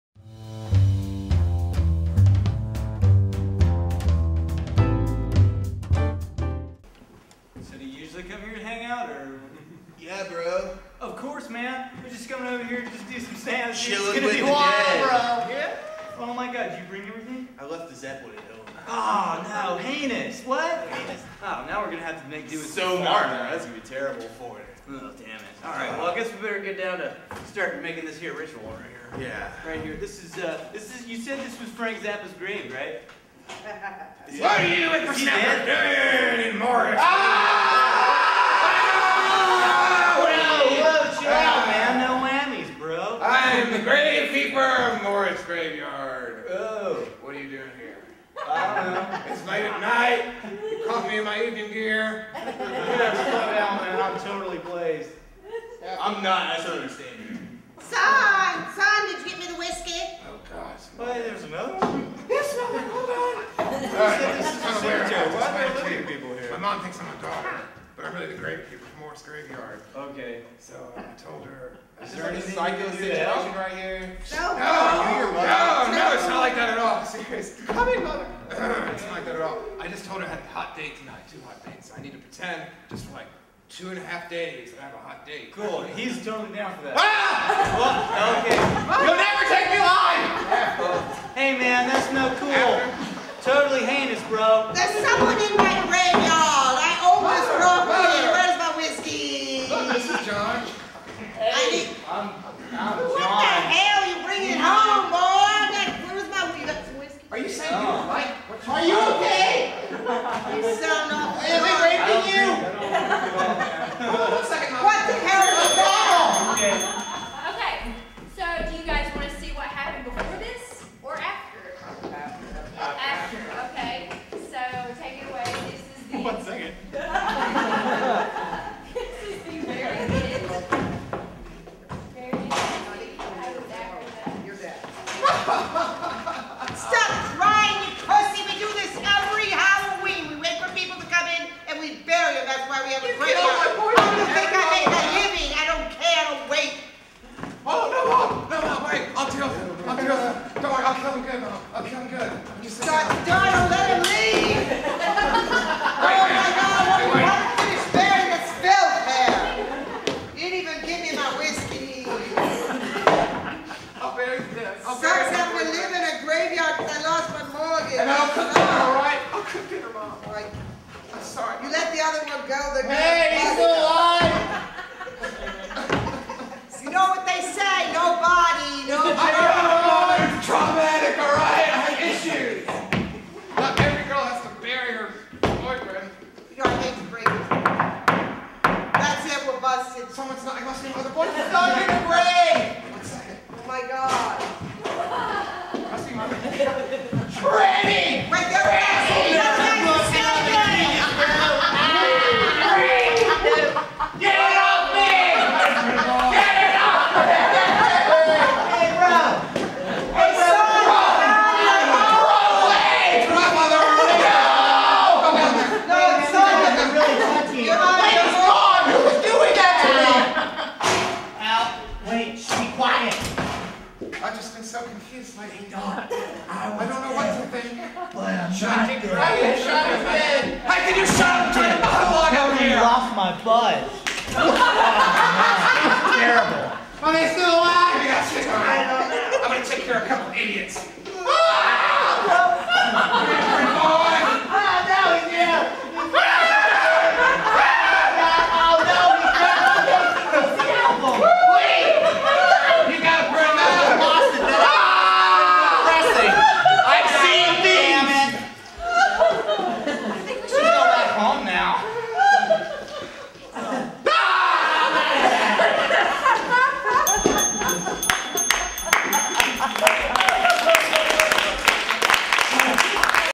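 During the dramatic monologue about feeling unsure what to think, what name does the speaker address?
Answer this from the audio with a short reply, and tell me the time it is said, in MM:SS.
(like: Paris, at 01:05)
Don, at 03:45.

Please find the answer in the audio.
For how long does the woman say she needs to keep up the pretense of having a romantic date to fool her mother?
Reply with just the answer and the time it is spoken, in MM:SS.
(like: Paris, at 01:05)
two and a half days, at 01:23.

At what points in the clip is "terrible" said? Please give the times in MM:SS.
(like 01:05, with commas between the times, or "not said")
00:23, 03:56.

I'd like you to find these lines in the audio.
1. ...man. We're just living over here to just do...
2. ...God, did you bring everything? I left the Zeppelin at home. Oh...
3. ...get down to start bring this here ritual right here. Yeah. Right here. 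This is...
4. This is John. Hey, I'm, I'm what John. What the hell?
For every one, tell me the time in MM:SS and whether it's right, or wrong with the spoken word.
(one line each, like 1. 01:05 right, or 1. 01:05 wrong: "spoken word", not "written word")
1. 00:11 wrong: "coming", not "living"
2. 00:16 right
3. 00:26 wrong: "making", not "bring"
4. 01:39 right.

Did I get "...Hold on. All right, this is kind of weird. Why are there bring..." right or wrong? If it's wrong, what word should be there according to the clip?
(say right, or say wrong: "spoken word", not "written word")
wrong: "living", not "bring".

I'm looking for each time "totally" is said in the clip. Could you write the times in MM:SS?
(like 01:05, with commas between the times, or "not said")
00:54, 01:26, 01:33.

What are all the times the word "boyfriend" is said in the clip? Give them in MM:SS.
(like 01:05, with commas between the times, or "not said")
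03:05, 03:11.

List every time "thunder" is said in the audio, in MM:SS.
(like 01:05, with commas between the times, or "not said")
not said.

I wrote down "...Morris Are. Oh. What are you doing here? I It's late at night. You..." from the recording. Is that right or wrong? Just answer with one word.
wrong.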